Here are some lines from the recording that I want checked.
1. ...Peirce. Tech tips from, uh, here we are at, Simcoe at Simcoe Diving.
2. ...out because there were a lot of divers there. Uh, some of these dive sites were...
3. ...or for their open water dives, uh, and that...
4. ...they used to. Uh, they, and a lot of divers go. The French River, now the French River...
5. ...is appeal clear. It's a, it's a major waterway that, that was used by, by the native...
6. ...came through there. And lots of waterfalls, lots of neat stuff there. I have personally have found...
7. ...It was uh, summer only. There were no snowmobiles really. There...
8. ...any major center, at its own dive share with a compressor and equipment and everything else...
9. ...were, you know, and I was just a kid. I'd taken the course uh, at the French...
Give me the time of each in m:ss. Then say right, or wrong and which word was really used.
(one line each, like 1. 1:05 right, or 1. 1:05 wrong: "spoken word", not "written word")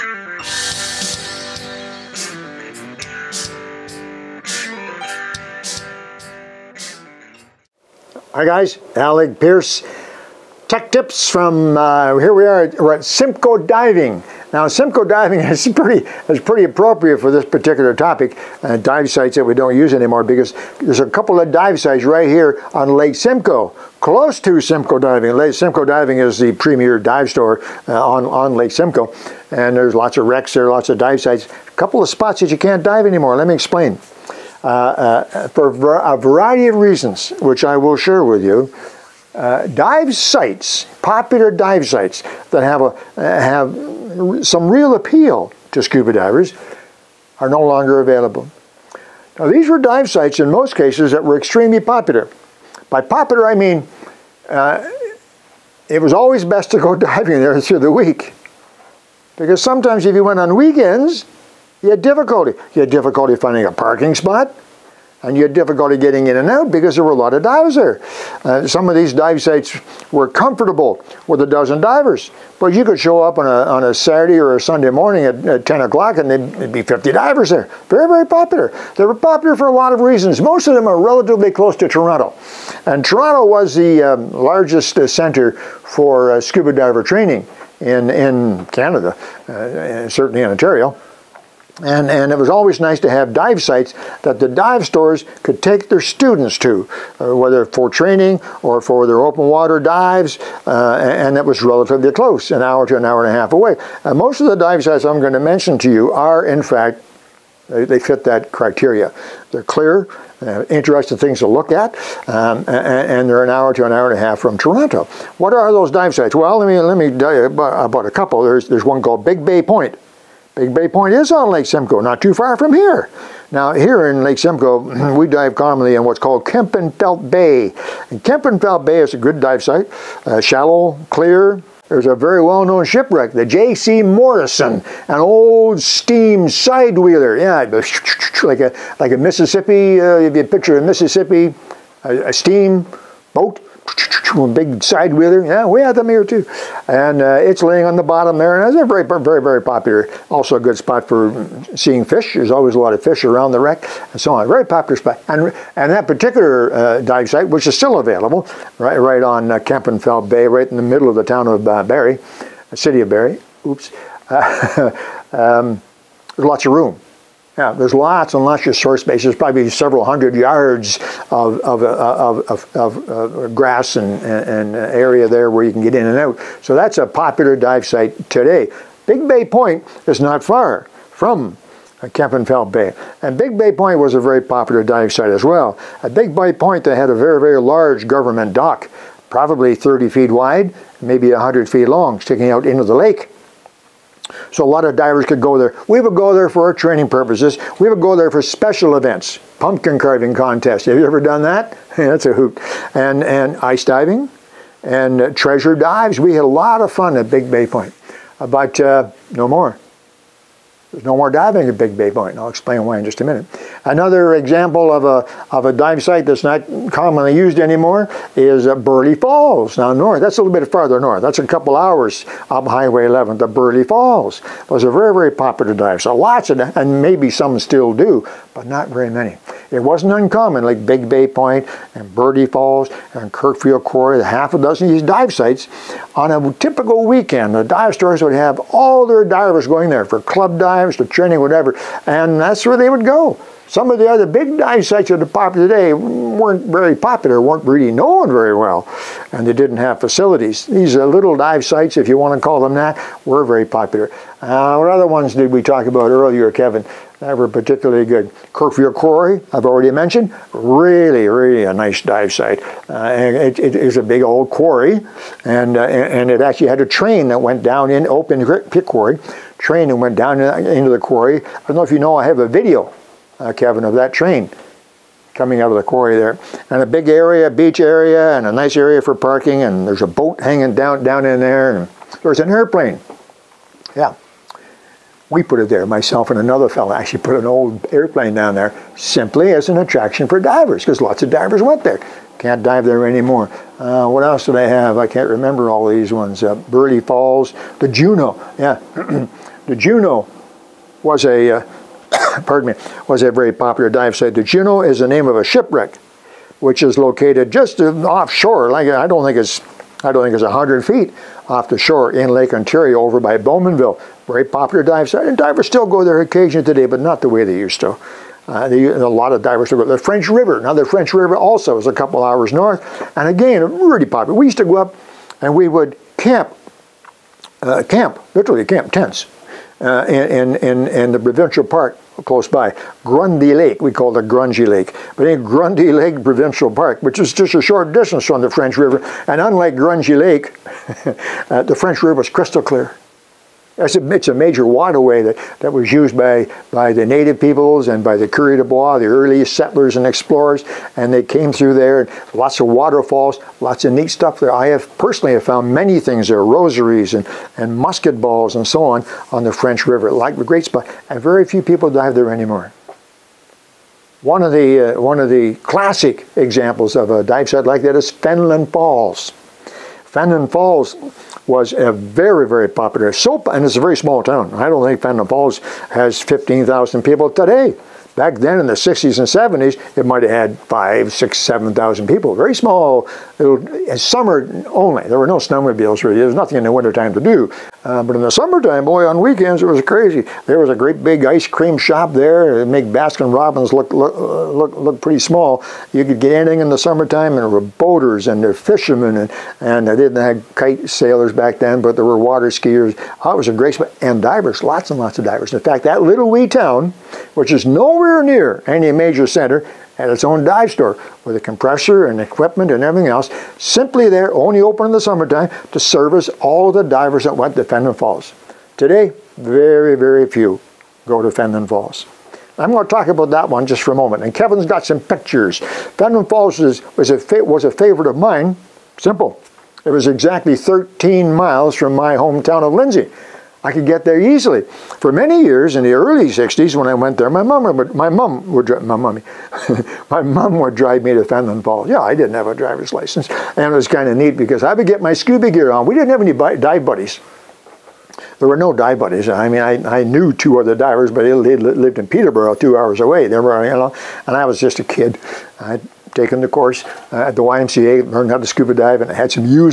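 1. 0:09 right
2. 1:06 right
3. 1:38 right
4. 5:17 right
5. 5:42 wrong: "crystal", not "appeal"
6. 5:51 right
7. 6:23 right
8. 6:48 wrong: "store", not "share"
9. 7:33 wrong: "YMCA", not "French".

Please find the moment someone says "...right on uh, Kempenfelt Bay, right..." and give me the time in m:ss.
2:38.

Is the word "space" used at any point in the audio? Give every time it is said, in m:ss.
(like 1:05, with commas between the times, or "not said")
2:49.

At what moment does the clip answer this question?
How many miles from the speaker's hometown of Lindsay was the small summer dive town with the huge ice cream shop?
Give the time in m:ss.
7:10.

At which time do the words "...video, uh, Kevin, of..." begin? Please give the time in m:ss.
4:32.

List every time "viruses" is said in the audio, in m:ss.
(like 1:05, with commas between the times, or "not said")
not said.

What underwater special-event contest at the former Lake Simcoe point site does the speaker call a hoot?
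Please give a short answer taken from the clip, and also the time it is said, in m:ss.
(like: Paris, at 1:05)
pumpkin carving contest, at 3:19.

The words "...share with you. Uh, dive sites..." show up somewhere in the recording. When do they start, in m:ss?
0:37.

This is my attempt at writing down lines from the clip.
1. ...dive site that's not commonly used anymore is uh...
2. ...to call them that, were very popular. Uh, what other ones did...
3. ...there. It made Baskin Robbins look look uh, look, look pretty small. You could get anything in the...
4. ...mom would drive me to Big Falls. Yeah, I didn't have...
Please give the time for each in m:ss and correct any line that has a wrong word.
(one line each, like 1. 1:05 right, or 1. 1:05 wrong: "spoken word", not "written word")
1. 3:35 right
2. 4:12 right
3. 6:32 right
4. 7:20 wrong: "Fenelon", not "Big".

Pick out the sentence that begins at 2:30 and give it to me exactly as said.
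Also a good spot for seeing fish.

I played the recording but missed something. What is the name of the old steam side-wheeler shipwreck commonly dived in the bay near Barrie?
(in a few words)
J.C. Morrison.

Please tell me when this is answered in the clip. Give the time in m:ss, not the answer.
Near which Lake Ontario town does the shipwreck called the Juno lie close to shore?
5:13.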